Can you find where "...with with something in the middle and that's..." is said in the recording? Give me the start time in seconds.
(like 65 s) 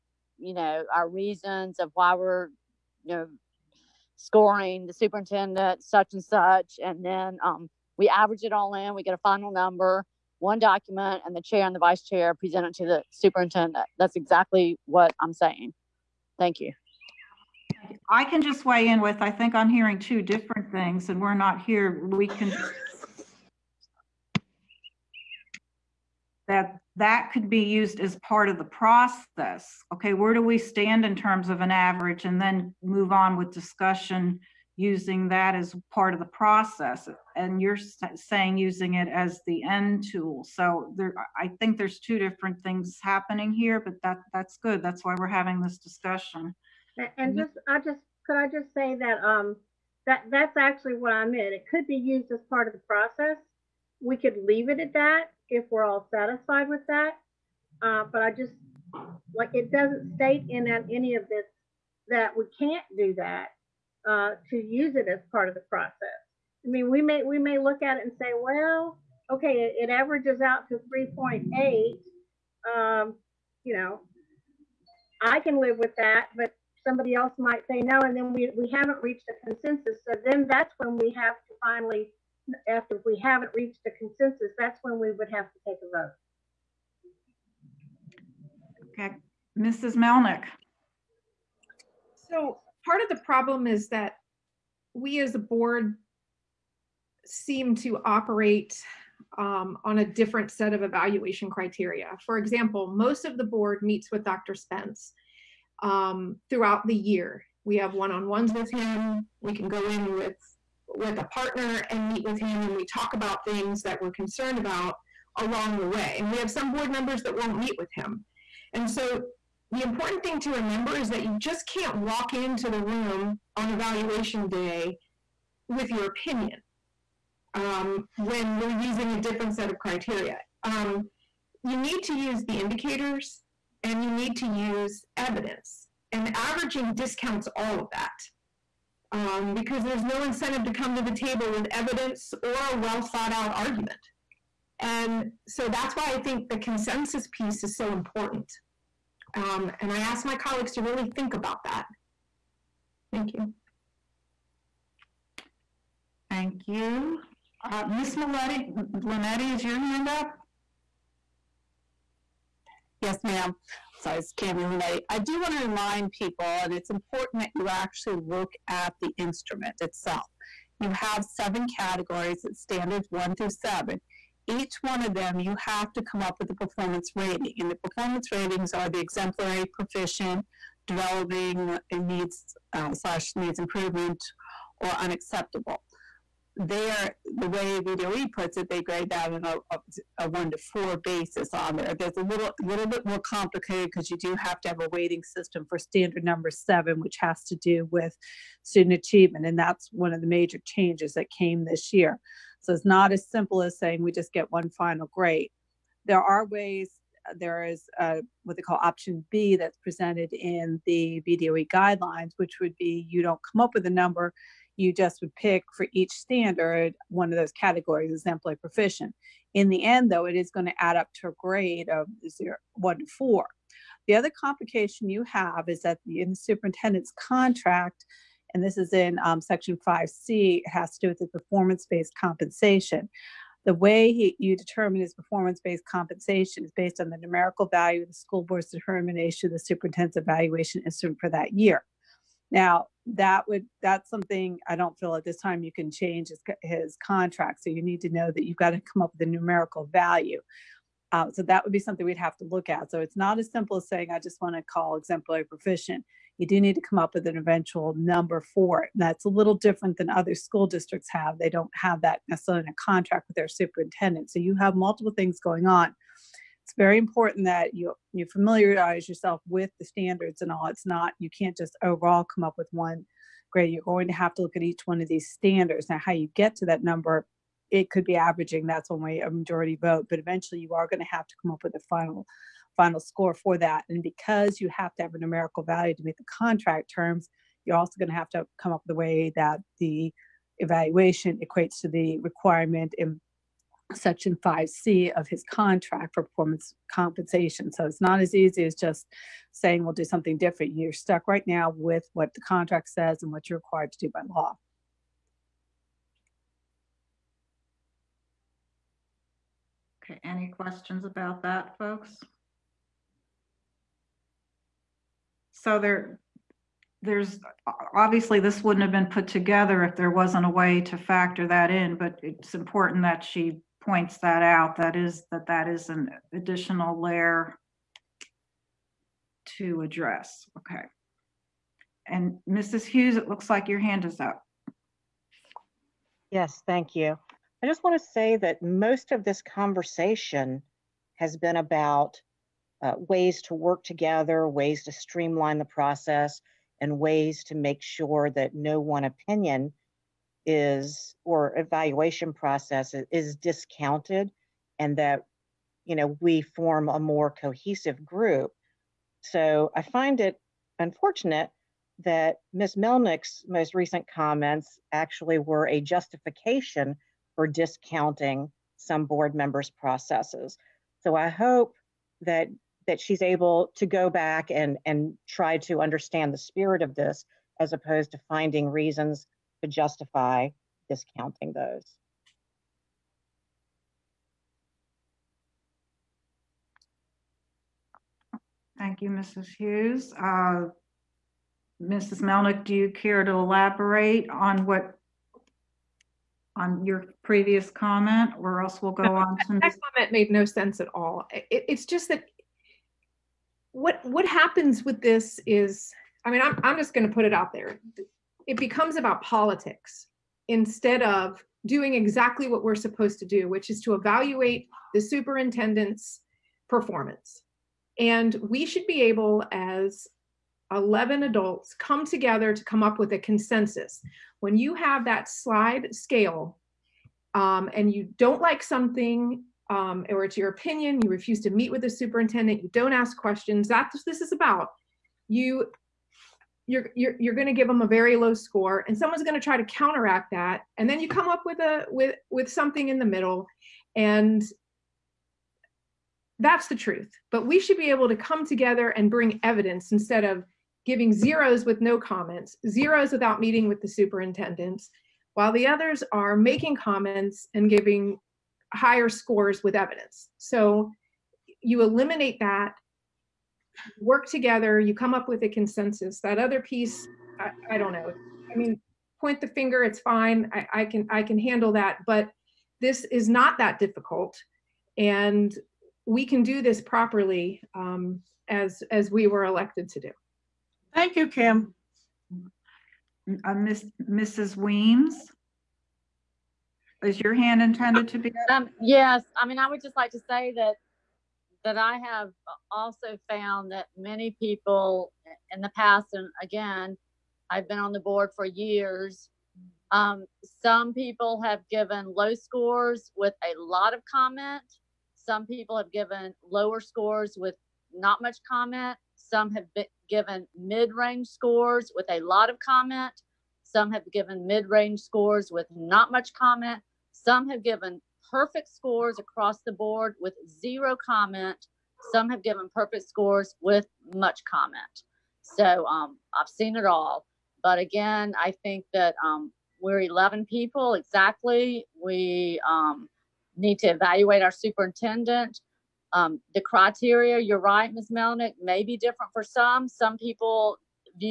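441 s.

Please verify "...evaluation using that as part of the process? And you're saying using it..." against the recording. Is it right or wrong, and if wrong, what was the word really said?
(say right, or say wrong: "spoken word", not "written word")
wrong: "discussion", not "evaluation".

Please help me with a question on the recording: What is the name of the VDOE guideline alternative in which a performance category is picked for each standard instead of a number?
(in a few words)
option B.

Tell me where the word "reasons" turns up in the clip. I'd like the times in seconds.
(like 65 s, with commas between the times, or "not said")
1 s, 378 s.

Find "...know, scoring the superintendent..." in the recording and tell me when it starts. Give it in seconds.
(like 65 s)
3 s.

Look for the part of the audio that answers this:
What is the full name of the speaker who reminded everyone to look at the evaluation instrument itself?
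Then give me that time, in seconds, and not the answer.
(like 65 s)
164 s.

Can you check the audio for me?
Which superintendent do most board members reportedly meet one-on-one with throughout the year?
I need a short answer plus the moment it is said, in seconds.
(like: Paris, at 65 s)
Dr. Spence, at 104 s.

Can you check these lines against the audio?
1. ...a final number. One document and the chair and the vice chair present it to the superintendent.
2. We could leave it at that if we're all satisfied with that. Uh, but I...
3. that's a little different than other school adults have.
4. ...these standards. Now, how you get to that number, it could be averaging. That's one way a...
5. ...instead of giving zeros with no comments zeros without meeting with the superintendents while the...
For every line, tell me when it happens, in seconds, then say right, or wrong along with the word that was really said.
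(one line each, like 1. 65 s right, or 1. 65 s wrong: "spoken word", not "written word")
1. 9 s right
2. 54 s right
3. 258 s wrong: "districts", not "adults"
4. 275 s right
5. 449 s right.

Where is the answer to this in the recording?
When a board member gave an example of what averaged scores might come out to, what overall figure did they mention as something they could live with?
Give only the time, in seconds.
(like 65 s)
70 s.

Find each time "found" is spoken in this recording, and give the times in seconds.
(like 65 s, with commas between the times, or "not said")
493 s.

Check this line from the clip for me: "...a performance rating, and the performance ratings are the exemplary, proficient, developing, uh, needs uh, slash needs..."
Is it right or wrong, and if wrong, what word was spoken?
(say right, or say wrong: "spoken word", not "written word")
right.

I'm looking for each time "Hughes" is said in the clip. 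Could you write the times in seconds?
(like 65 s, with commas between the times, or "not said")
332 s, 389 s.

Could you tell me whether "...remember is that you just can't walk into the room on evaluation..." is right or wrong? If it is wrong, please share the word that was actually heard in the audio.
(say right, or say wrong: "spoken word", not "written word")
right.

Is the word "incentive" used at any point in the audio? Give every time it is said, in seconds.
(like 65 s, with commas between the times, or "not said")
140 s.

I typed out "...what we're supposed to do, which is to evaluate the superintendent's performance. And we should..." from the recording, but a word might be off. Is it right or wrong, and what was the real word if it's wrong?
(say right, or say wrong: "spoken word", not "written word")
right.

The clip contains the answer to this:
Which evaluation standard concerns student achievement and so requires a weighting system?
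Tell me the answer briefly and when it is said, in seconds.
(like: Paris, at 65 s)
standard number seven, at 195 s.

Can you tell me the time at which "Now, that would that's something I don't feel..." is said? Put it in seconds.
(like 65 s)
242 s.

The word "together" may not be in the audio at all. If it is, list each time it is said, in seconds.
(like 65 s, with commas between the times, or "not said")
319 s, 343 s, 422 s, 448 s, 464 s.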